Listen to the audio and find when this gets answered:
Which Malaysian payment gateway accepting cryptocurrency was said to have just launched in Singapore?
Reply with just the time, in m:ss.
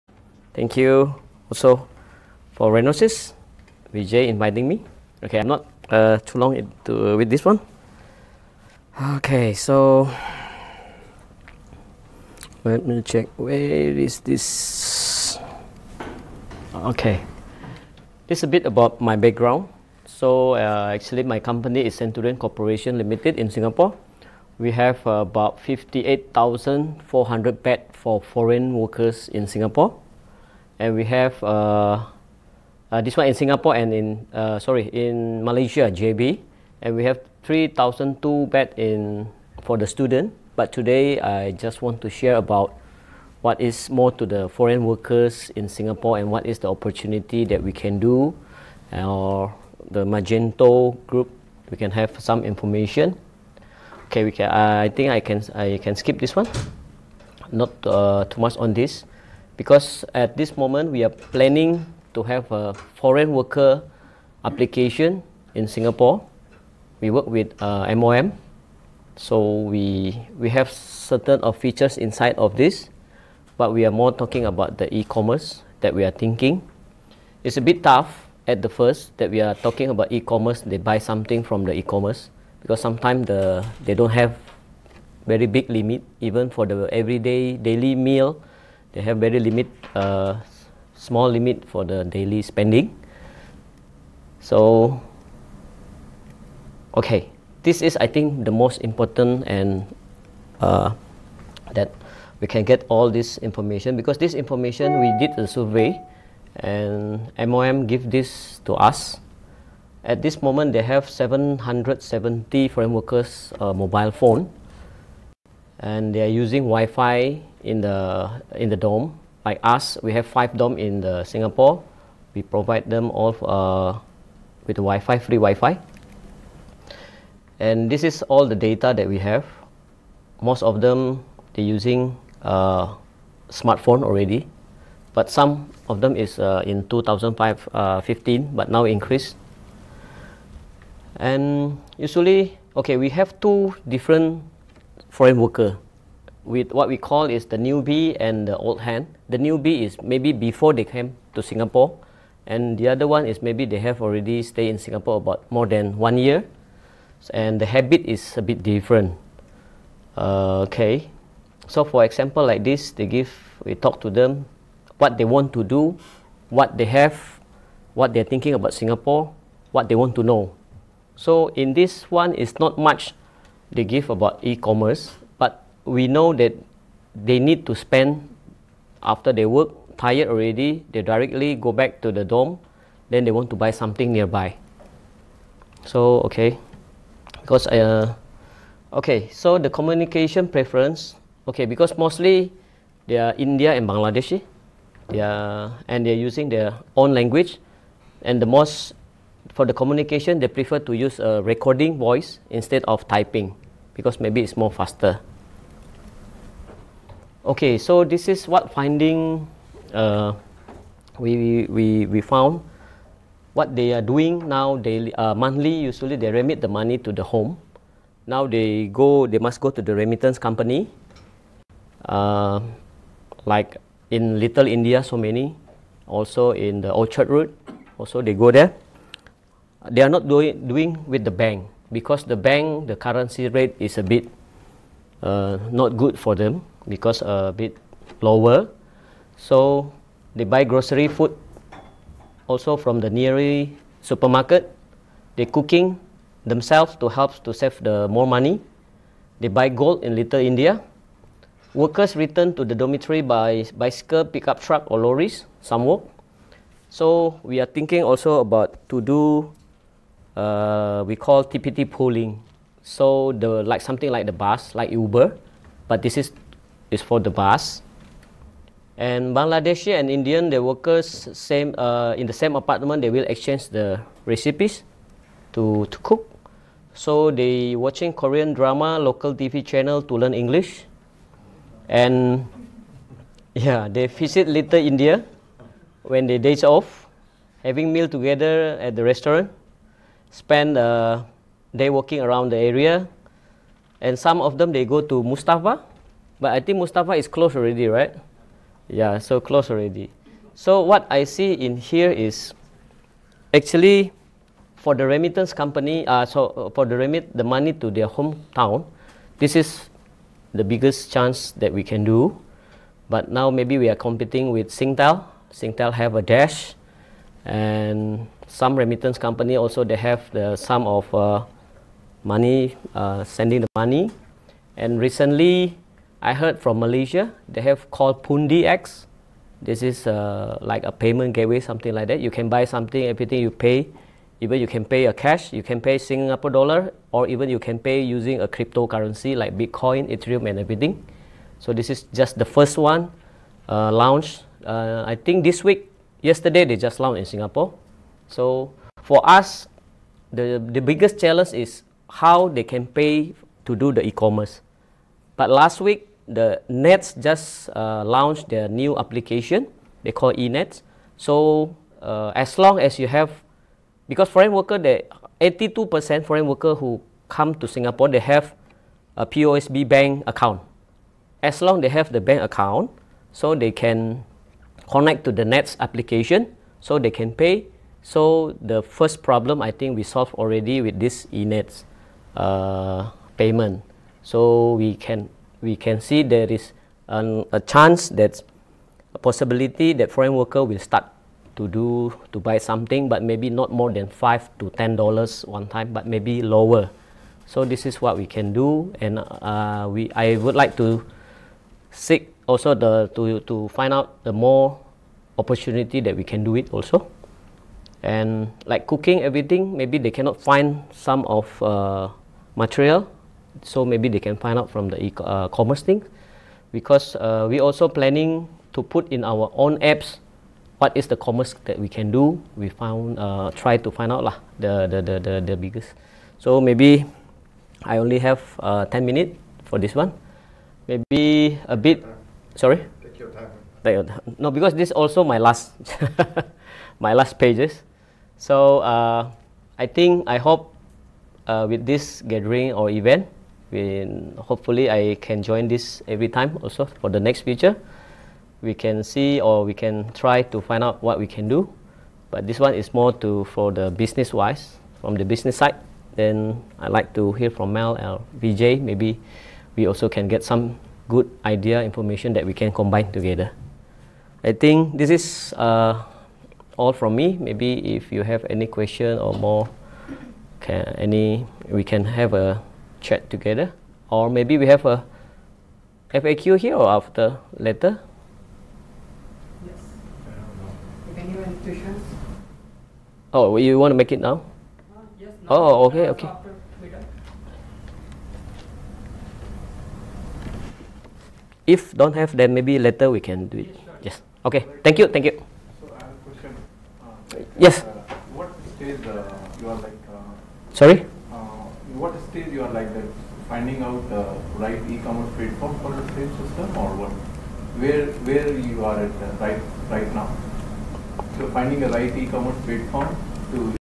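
5:28.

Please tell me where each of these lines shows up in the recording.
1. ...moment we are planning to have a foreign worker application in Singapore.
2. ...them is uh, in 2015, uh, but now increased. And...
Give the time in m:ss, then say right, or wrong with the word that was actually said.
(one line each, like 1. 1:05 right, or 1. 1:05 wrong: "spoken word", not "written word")
1. 1:00 right
2. 2:16 right.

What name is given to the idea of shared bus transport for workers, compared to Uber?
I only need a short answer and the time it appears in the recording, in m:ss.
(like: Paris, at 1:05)
TPT pooling, at 4:21.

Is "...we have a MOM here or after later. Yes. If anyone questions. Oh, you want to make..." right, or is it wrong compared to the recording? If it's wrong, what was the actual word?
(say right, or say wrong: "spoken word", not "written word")
wrong: "FAQ", not "MOM".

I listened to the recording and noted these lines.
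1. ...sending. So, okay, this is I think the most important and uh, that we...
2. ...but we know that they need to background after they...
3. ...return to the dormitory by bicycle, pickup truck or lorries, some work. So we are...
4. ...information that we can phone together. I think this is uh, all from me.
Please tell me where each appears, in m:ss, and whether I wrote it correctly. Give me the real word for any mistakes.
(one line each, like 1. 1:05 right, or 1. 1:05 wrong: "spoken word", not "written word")
1. 1:32 wrong: "spending", not "sending"
2. 2:55 wrong: "spend", not "background"
3. 4:12 right
4. 7:41 wrong: "combine", not "phone".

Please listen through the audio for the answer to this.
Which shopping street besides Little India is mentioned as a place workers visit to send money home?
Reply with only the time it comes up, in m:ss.
3:46.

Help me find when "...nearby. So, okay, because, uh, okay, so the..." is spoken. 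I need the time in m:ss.
3:04.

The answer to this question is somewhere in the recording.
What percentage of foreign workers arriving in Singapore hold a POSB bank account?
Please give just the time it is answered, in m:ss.
6:05.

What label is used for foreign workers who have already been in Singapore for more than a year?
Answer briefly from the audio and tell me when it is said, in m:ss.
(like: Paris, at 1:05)
old hand, at 2:28.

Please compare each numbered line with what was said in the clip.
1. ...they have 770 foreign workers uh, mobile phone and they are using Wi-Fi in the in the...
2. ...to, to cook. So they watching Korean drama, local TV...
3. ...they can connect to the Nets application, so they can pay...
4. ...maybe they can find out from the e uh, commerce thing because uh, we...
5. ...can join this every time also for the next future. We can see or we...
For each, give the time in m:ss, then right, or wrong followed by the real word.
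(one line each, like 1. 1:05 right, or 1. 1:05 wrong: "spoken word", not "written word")
1. 1:50 right
2. 4:35 right
3. 6:13 right
4. 6:53 right
5. 7:25 right.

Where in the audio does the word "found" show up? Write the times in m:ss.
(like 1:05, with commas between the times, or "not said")
3:32, 7:02.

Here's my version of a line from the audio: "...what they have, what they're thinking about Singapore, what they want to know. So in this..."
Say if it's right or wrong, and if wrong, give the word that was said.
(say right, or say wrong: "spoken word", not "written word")
right.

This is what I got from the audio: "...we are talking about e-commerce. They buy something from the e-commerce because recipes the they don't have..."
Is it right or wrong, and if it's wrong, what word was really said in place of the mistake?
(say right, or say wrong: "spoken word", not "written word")
wrong: "sometimes", not "recipes".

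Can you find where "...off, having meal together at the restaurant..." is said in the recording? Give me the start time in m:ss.
4:46.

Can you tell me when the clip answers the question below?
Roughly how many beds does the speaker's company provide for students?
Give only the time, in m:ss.
0:37.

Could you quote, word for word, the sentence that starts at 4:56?
But I think Mustafa is closed already, right?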